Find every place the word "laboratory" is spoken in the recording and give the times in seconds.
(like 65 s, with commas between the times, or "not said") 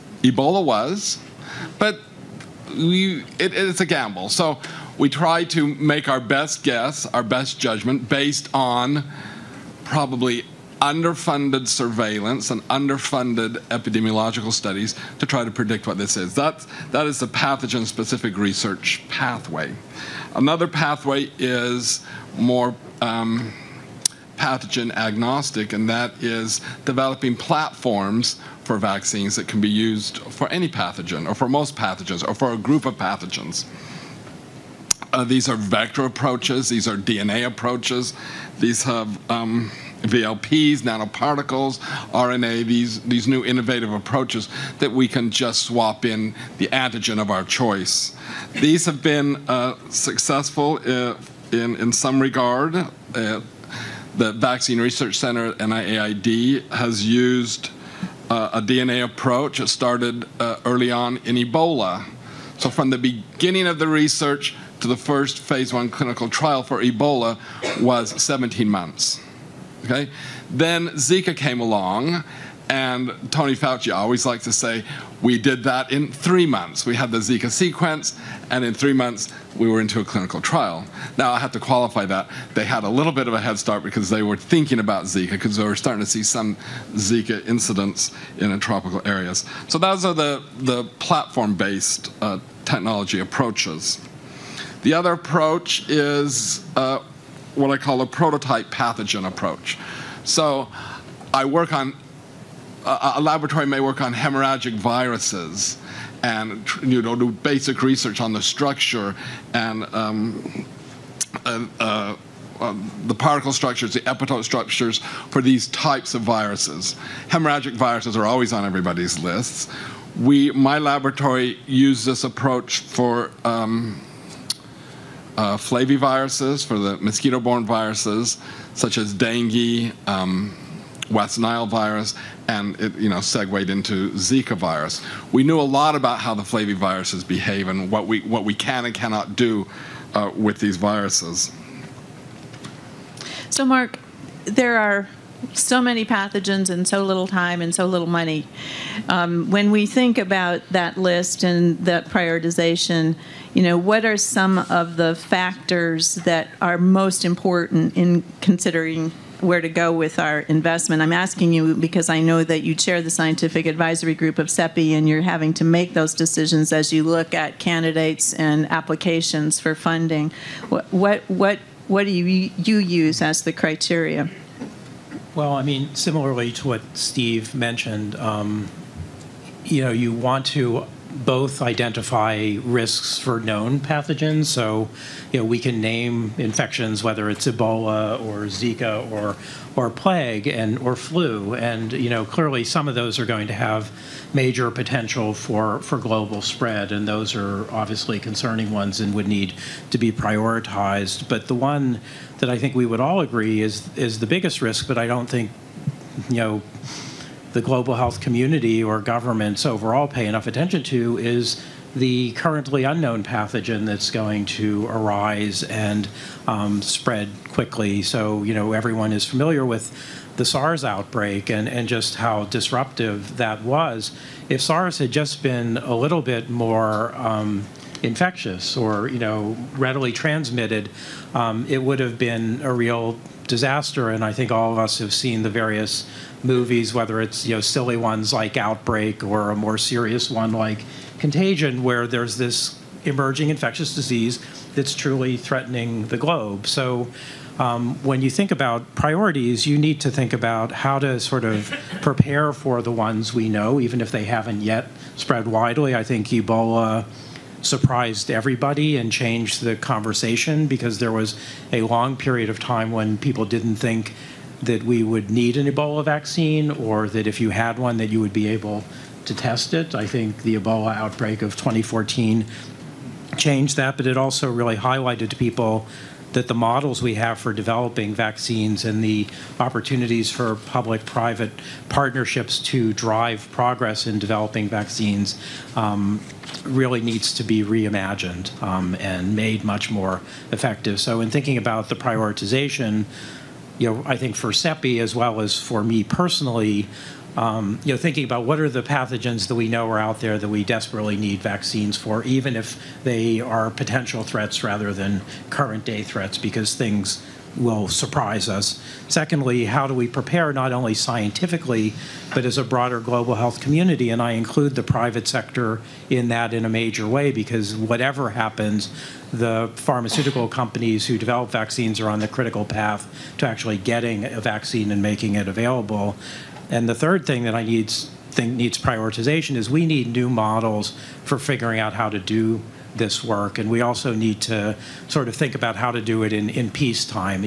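103 s, 120 s.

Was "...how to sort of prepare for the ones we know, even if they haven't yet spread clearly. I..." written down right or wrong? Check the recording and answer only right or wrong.
wrong.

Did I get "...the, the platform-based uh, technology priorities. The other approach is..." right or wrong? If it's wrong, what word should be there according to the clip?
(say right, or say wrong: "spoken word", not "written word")
wrong: "approaches", not "priorities".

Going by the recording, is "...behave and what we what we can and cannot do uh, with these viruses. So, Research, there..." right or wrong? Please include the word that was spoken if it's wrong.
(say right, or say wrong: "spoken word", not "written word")
wrong: "Mark", not "Research".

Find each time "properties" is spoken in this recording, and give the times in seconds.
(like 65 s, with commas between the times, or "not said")
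not said.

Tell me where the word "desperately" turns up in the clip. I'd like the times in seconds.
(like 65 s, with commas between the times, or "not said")
300 s.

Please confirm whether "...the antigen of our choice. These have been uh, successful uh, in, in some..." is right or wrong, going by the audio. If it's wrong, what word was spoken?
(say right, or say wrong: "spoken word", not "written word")
right.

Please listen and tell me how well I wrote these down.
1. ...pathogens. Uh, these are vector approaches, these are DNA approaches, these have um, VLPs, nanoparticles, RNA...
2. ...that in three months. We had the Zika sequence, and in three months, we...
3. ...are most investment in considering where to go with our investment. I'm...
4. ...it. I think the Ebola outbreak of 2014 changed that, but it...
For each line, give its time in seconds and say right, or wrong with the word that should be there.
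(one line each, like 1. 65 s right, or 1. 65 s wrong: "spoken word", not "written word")
1. 32 s right
2. 75 s right
3. 156 s wrong: "important", not "investment"
4. 269 s right.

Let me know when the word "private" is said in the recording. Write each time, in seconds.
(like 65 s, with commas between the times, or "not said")
281 s, 314 s.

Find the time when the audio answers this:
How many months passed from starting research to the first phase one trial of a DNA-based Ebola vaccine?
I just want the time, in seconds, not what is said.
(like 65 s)
68 s.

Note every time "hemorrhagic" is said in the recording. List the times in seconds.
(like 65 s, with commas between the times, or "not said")
104 s, 117 s.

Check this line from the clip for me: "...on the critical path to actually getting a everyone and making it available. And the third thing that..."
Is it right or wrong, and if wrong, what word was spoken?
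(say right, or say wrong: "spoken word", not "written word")
wrong: "vaccine", not "everyone".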